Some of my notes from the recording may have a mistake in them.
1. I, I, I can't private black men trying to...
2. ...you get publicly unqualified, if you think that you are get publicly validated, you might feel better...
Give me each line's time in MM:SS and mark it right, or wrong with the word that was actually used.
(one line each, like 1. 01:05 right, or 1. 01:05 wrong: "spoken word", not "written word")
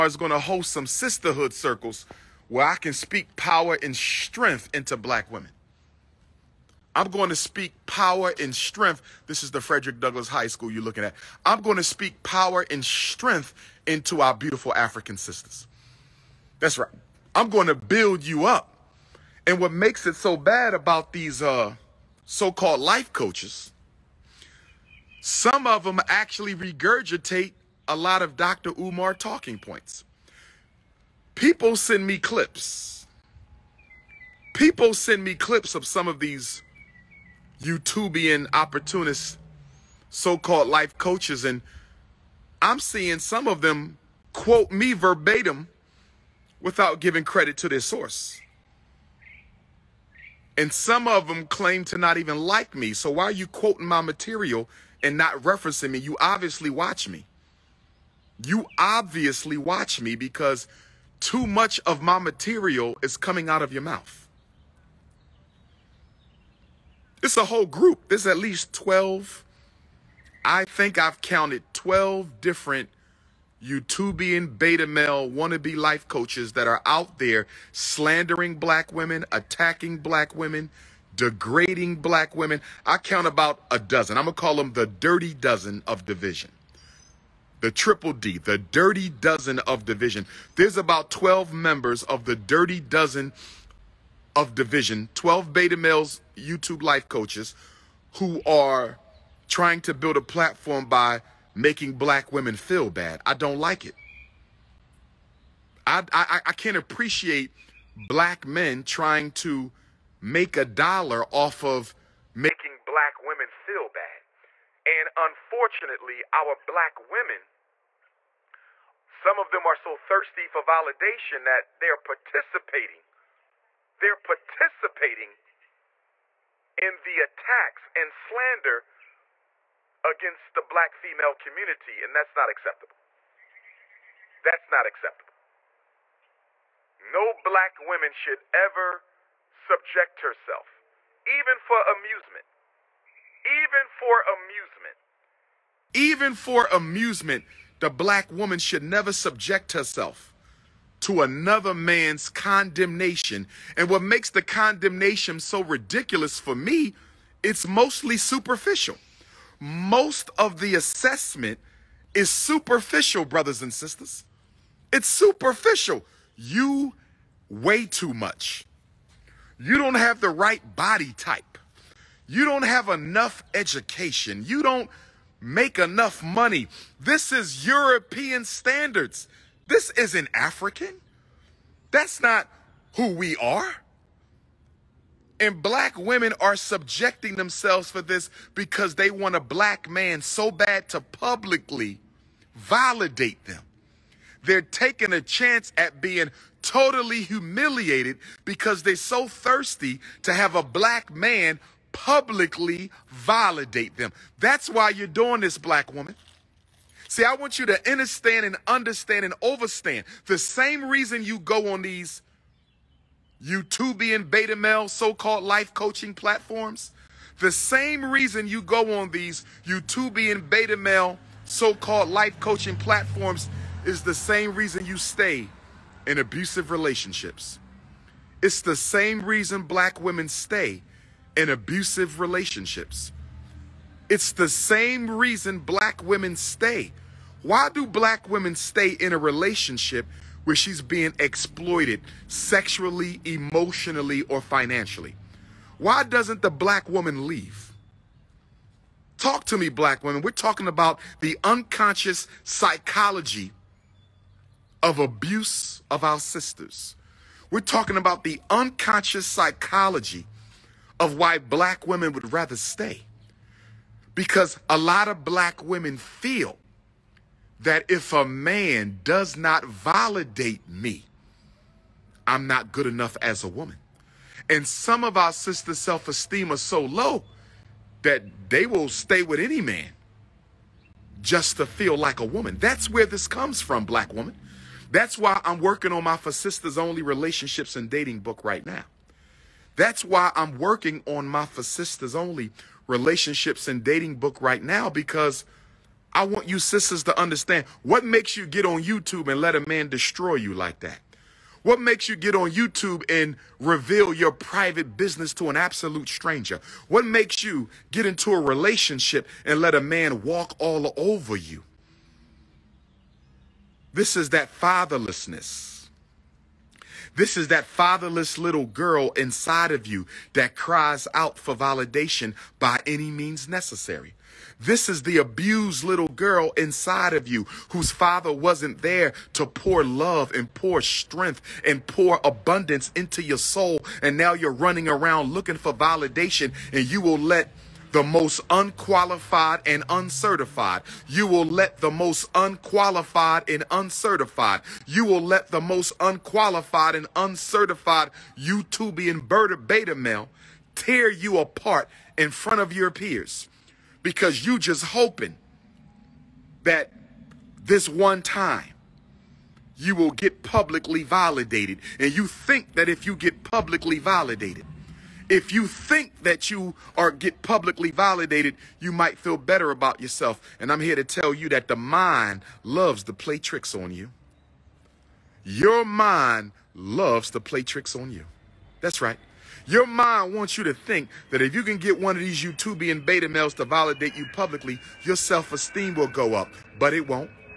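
1. 01:45 wrong: "appreciate", not "private"
2. 06:03 wrong: "validated", not "unqualified".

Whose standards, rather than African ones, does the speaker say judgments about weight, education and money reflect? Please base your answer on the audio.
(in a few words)
European standards.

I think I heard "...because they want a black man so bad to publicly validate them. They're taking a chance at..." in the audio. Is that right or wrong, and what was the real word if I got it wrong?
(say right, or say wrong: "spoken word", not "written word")
right.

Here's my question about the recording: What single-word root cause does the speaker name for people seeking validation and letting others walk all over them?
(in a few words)
fatherlessness.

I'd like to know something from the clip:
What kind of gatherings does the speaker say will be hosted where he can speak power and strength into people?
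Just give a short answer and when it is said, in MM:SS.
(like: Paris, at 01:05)
sisterhood circles, at 00:00.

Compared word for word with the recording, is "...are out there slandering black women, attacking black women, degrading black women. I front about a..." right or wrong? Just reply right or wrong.
wrong.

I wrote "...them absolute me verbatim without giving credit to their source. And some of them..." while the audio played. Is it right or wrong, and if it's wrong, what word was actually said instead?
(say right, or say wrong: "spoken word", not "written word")
wrong: "quote", not "absolute".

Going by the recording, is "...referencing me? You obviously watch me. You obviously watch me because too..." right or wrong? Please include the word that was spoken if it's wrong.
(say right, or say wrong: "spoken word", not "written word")
right.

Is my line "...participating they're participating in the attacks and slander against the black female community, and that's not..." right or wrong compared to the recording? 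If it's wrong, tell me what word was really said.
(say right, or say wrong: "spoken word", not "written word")
right.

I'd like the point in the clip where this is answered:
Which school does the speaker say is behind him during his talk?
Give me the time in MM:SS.
00:09.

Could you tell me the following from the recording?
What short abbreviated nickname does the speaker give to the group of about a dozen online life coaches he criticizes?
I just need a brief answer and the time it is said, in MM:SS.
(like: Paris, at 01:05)
the triple D, at 01:27.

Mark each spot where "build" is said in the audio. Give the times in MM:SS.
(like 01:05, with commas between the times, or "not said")
00:17, 01:39.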